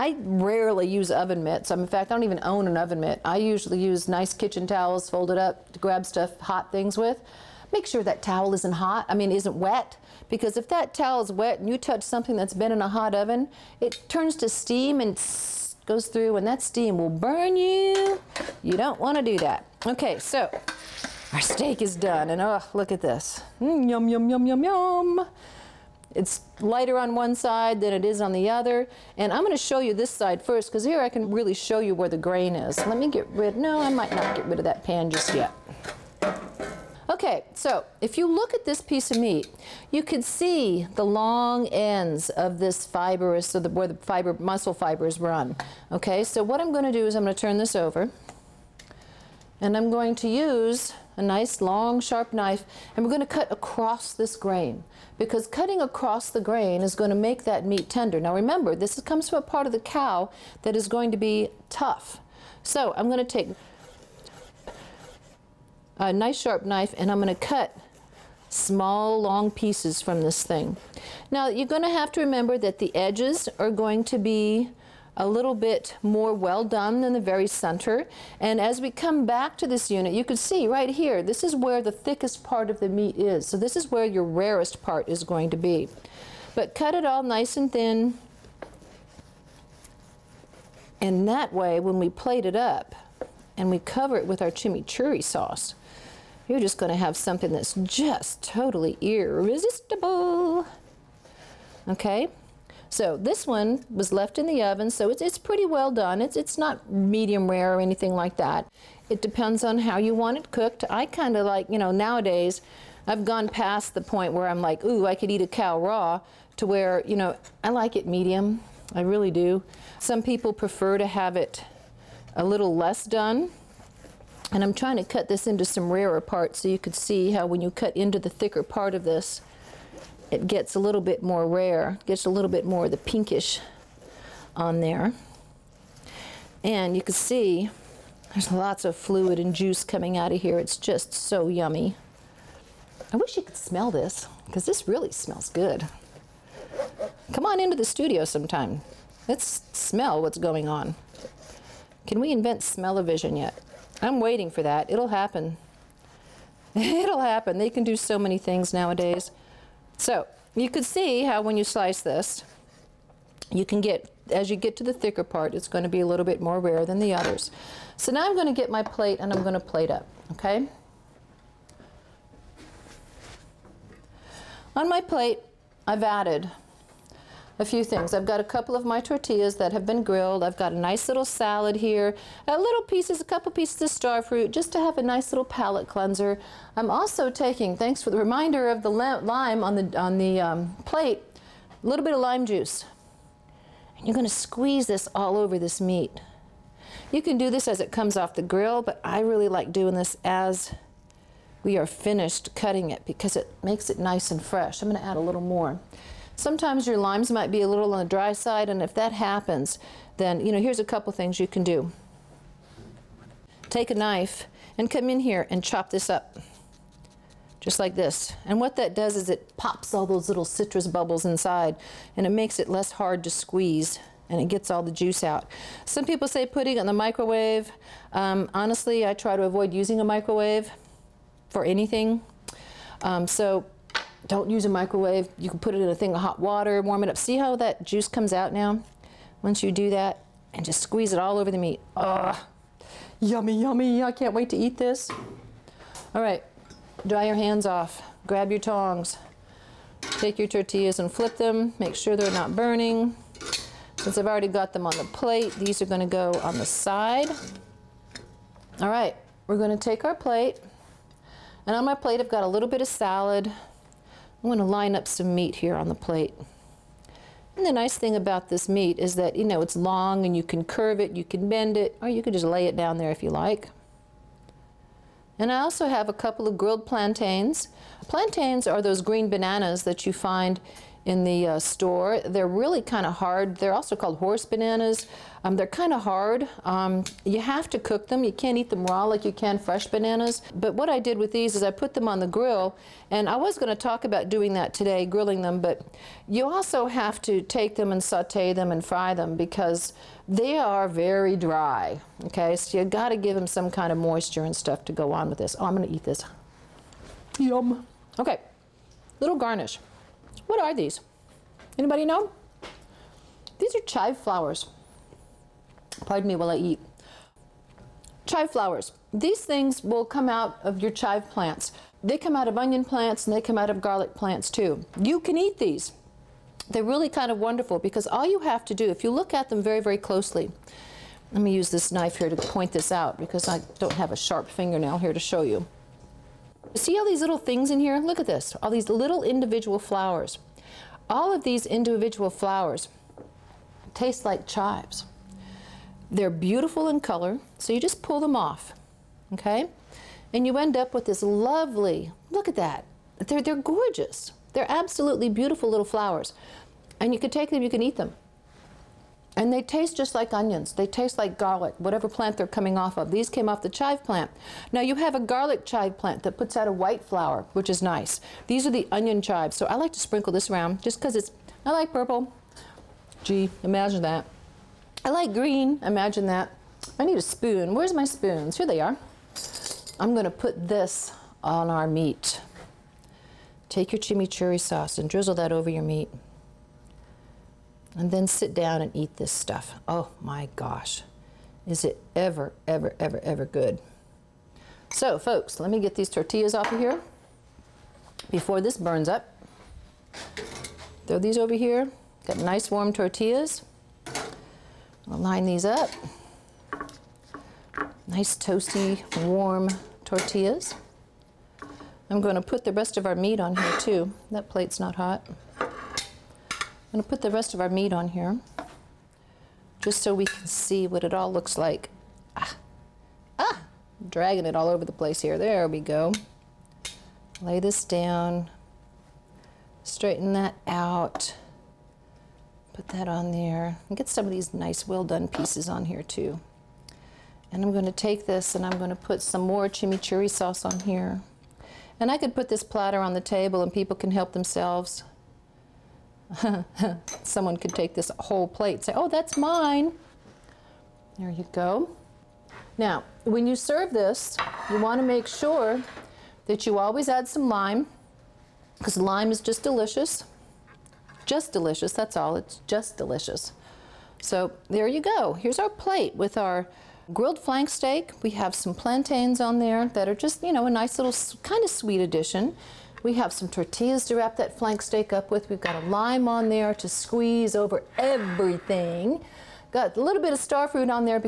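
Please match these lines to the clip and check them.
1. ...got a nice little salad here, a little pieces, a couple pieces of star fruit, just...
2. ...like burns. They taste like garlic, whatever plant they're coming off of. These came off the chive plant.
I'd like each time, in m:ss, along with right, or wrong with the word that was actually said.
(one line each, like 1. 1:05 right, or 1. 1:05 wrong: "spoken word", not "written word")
1. 3:00 right
2. 6:00 wrong: "onions", not "burns".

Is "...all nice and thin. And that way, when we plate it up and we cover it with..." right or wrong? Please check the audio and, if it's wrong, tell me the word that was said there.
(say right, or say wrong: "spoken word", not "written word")
right.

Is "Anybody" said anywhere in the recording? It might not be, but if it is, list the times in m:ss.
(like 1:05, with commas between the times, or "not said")
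5:11.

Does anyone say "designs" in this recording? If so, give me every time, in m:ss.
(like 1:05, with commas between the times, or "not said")
not said.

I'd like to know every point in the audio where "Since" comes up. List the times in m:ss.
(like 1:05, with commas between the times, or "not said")
4:13.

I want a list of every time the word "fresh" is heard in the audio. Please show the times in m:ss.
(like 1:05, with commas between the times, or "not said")
3:24, 4:49.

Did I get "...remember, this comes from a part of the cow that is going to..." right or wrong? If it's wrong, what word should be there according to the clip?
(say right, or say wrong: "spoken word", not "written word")
right.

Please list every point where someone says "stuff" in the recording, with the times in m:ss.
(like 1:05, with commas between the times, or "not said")
0:06, 5:04, 6:29.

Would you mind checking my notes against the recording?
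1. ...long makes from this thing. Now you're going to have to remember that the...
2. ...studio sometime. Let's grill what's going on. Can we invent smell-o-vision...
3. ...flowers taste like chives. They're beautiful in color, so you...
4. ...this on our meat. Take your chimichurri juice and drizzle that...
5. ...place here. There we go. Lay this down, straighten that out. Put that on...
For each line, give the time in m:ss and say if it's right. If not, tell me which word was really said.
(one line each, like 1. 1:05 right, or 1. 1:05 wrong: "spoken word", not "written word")
1. 1:09 wrong: "pieces", not "makes"
2. 2:27 wrong: "smell", not "grill"
3. 5:42 right
4. 6:20 wrong: "sauce", not "juice"
5. 7:04 right.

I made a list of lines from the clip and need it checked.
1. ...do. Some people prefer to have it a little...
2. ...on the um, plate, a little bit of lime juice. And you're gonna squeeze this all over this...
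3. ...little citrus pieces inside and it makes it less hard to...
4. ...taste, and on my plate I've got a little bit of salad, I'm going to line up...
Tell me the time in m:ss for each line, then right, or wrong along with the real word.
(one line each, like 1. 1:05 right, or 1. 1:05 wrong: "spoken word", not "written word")
1. 1:59 right
2. 3:09 right
3. 3:40 wrong: "bubbles", not "pieces"
4. 4:20 wrong: "plate", not "taste".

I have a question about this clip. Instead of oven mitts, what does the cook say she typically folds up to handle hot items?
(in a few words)
Kitchen towels.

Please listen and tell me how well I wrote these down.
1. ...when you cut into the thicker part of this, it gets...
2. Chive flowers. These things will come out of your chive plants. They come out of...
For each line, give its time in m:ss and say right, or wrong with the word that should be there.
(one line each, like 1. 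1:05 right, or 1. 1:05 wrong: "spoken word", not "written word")
1. 2:07 right
2. 5:18 right.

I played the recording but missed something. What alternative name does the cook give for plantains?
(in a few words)
Horse bananas.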